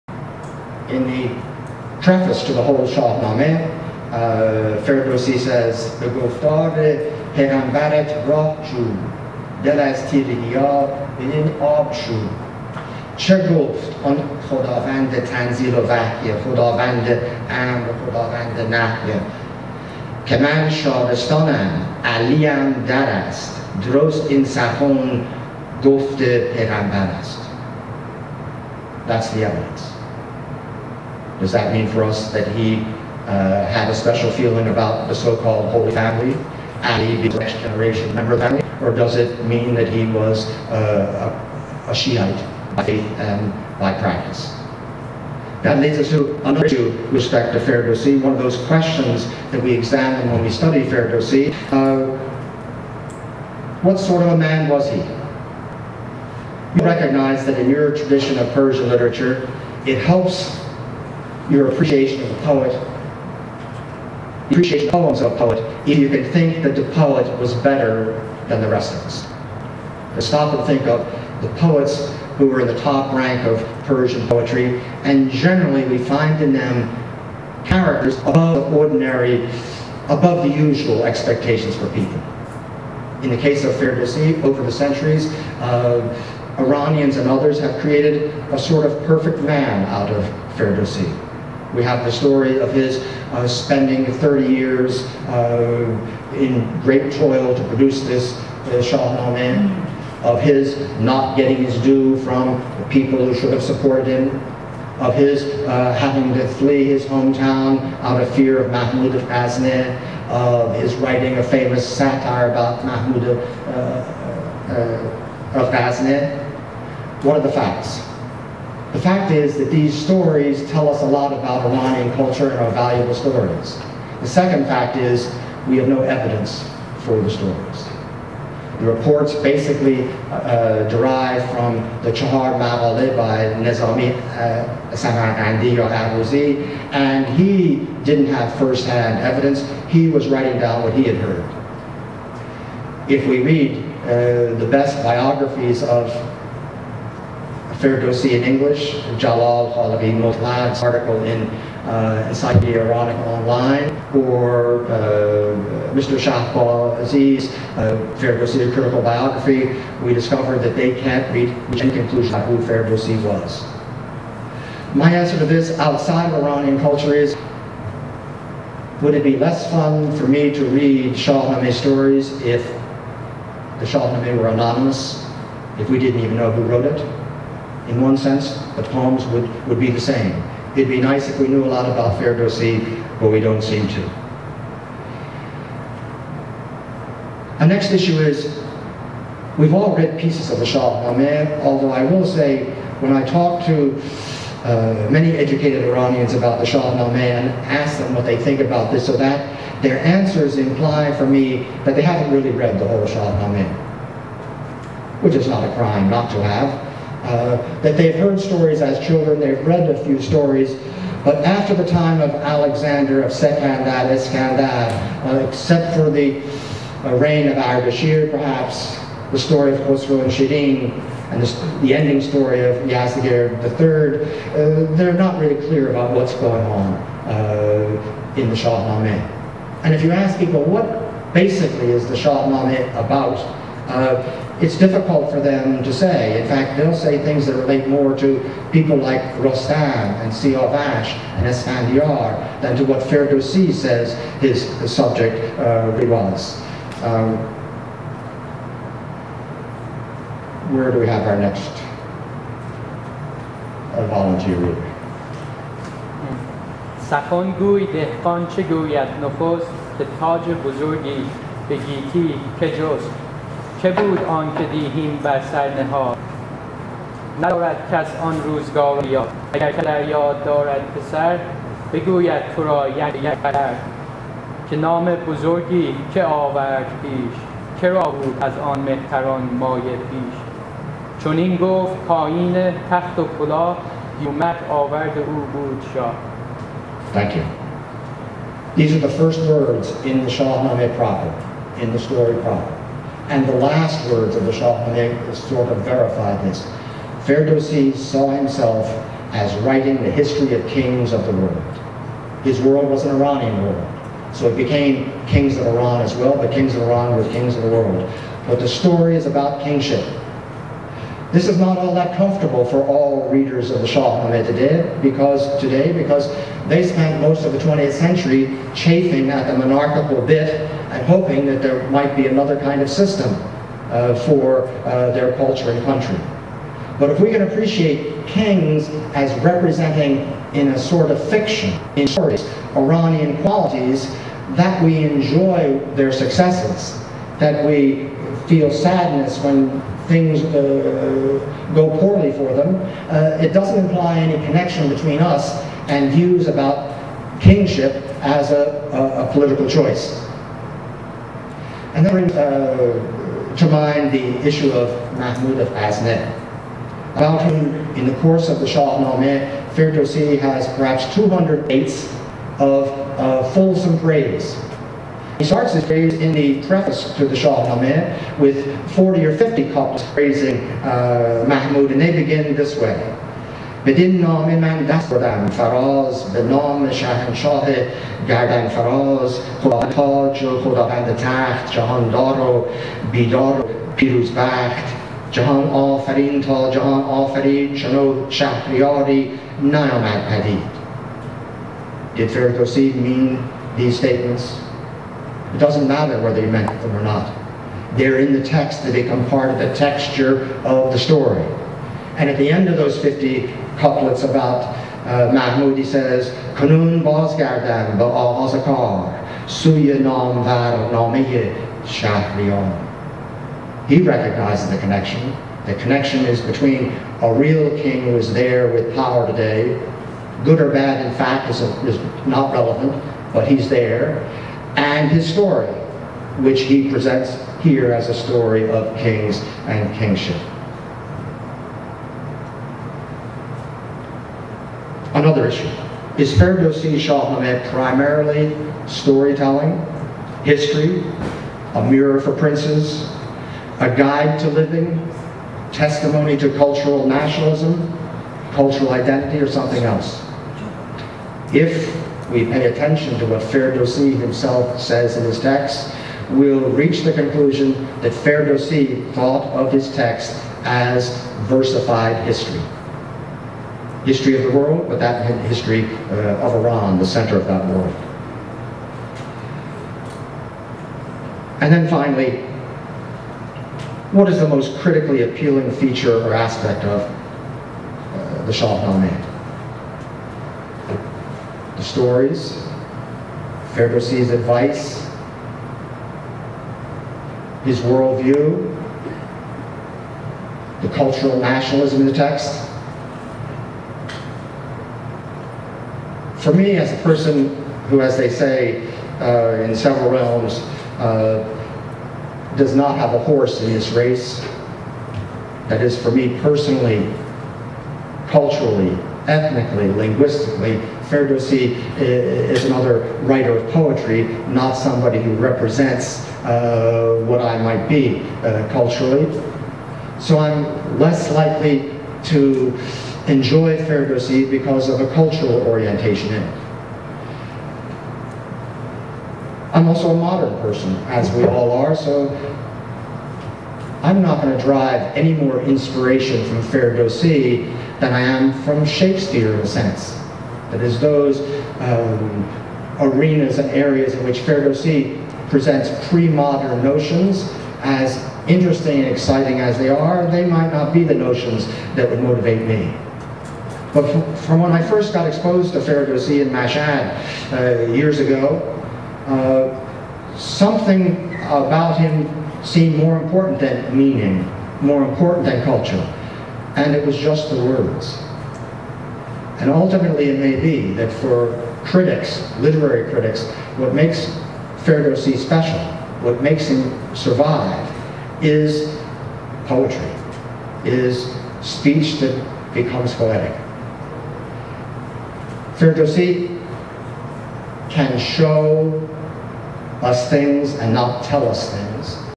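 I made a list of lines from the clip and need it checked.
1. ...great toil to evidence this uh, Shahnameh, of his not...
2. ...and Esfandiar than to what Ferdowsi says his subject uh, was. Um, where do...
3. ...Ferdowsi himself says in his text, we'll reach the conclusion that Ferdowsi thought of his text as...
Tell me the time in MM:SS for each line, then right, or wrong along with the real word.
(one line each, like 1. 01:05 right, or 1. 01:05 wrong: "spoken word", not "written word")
1. 01:36 wrong: "produce", not "evidence"
2. 04:01 right
3. 07:33 right.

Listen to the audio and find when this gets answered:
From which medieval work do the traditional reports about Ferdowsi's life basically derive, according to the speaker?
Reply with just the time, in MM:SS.
02:12.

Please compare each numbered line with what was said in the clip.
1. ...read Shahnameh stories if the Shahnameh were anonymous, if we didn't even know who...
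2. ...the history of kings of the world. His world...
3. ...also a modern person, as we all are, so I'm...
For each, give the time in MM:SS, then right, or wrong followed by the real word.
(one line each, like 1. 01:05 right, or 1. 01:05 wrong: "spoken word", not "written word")
1. 02:50 right
2. 05:00 right
3. 08:49 right.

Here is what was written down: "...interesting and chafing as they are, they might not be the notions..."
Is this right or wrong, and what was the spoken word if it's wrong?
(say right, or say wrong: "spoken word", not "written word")
wrong: "exciting", not "chafing".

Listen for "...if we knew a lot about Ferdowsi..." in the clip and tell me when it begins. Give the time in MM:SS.
03:01.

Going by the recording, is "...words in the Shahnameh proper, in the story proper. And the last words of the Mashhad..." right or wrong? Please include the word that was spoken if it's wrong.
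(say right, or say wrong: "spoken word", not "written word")
wrong: "Shahnameh", not "Mashhad".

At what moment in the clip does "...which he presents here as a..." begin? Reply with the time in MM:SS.
07:06.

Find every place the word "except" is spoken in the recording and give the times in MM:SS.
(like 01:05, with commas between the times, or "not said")
03:35.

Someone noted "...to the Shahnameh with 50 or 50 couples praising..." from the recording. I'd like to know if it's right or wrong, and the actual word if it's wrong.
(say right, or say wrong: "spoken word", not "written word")
wrong: "40", not "50".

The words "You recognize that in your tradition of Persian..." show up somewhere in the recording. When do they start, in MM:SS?
00:56.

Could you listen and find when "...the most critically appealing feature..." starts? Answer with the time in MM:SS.
07:54.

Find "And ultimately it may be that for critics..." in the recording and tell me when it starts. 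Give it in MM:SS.
09:29.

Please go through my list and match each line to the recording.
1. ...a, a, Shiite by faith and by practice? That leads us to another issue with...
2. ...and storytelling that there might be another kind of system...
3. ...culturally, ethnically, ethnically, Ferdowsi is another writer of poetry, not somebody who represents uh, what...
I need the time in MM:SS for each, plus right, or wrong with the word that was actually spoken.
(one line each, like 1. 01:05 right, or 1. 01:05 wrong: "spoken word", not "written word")
1. 00:41 right
2. 05:20 wrong: "hoping", not "storytelling"
3. 08:28 wrong: "linguistically", not "ethnically".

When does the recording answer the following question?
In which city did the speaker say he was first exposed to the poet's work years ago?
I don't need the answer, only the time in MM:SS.
09:16.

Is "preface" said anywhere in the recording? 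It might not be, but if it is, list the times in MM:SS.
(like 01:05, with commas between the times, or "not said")
00:02, 06:06.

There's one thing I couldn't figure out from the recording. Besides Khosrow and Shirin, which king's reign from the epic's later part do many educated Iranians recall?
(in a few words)
Ardashir.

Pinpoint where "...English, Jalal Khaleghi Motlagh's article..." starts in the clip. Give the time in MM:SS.
02:28.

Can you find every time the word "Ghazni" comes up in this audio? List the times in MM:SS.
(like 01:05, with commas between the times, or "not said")
01:49, 01:55, 05:55.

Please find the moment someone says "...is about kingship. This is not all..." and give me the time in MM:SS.
05:09.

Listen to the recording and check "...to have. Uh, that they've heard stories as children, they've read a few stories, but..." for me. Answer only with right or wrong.
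right.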